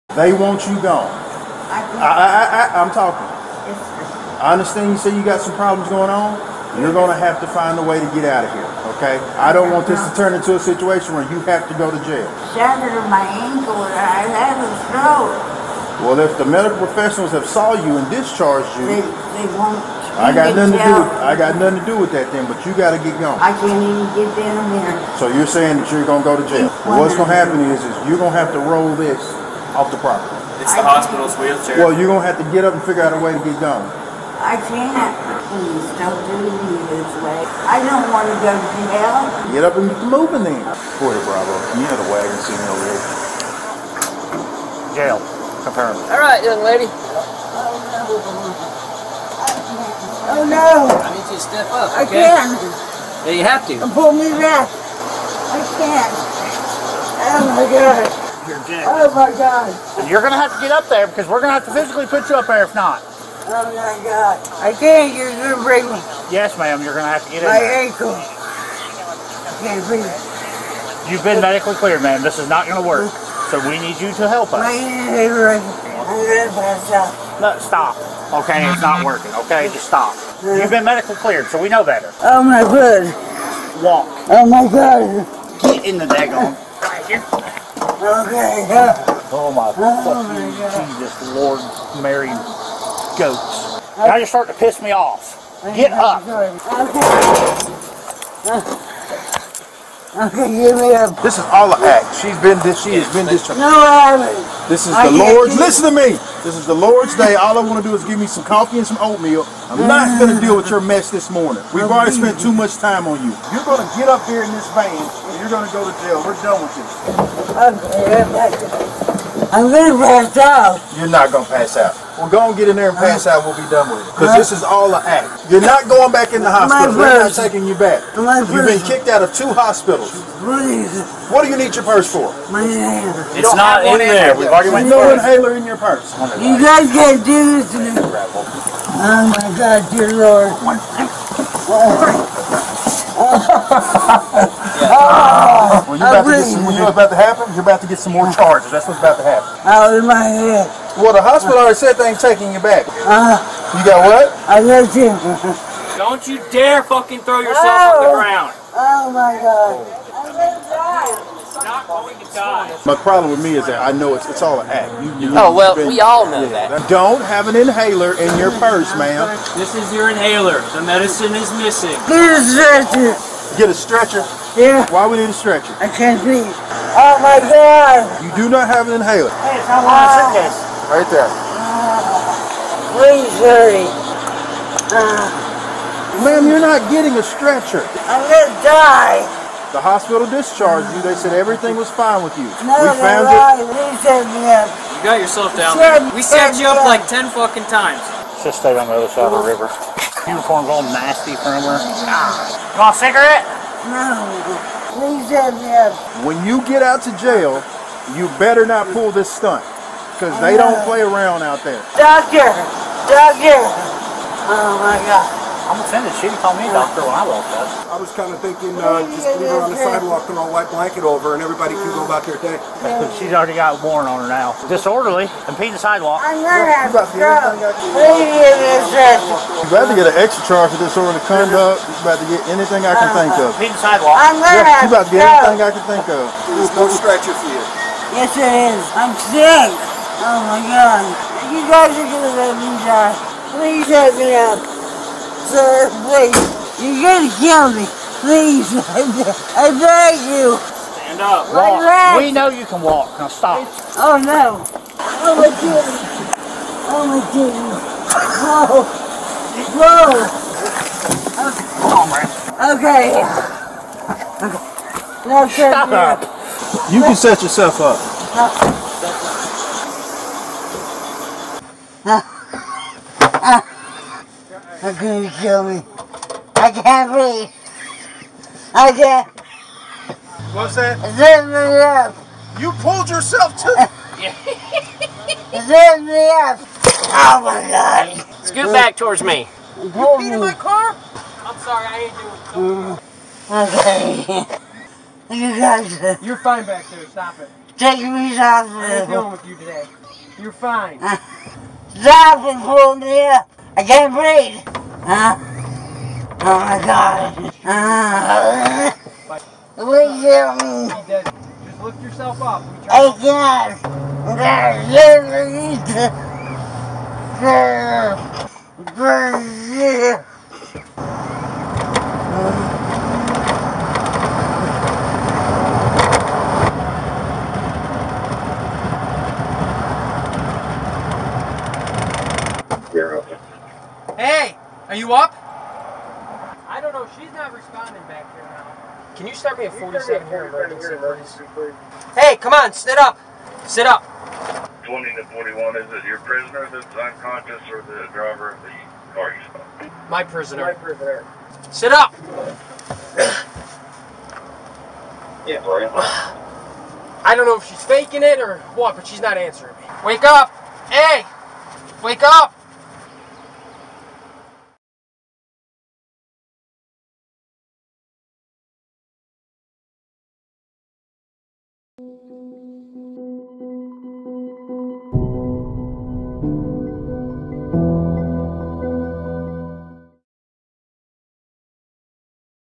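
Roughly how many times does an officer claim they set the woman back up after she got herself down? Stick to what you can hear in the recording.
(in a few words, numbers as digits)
10.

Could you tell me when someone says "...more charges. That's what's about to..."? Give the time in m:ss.
2:28.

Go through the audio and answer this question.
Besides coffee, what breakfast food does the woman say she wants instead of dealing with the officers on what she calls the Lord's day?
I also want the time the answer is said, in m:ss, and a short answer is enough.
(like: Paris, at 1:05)
oatmeal, at 1:48.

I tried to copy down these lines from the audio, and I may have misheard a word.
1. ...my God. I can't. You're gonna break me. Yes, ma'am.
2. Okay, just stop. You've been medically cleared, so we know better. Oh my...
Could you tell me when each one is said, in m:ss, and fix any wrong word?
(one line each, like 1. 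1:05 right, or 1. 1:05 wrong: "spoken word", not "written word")
1. 1:03 right
2. 1:19 right.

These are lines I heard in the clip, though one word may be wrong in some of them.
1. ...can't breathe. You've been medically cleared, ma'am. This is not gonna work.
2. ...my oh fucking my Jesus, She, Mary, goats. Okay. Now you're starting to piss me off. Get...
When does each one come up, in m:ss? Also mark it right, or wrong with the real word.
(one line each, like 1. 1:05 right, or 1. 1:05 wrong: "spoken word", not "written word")
1. 1:09 right
2. 1:29 wrong: "Lord", not "She".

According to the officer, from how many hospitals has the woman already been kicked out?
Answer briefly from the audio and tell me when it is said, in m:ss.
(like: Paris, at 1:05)
2, at 2:09.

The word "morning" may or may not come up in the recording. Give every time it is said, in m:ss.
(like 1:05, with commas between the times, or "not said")
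1:51.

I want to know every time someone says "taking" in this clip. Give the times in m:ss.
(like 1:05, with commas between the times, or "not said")
2:07, 2:32.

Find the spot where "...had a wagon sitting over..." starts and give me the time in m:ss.
0:41.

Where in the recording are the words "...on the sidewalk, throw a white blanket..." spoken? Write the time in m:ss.
3:39.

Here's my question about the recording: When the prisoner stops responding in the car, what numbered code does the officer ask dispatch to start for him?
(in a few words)
47.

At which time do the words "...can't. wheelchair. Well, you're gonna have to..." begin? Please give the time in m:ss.
0:31.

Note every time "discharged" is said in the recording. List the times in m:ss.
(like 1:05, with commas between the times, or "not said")
0:18, 3:10.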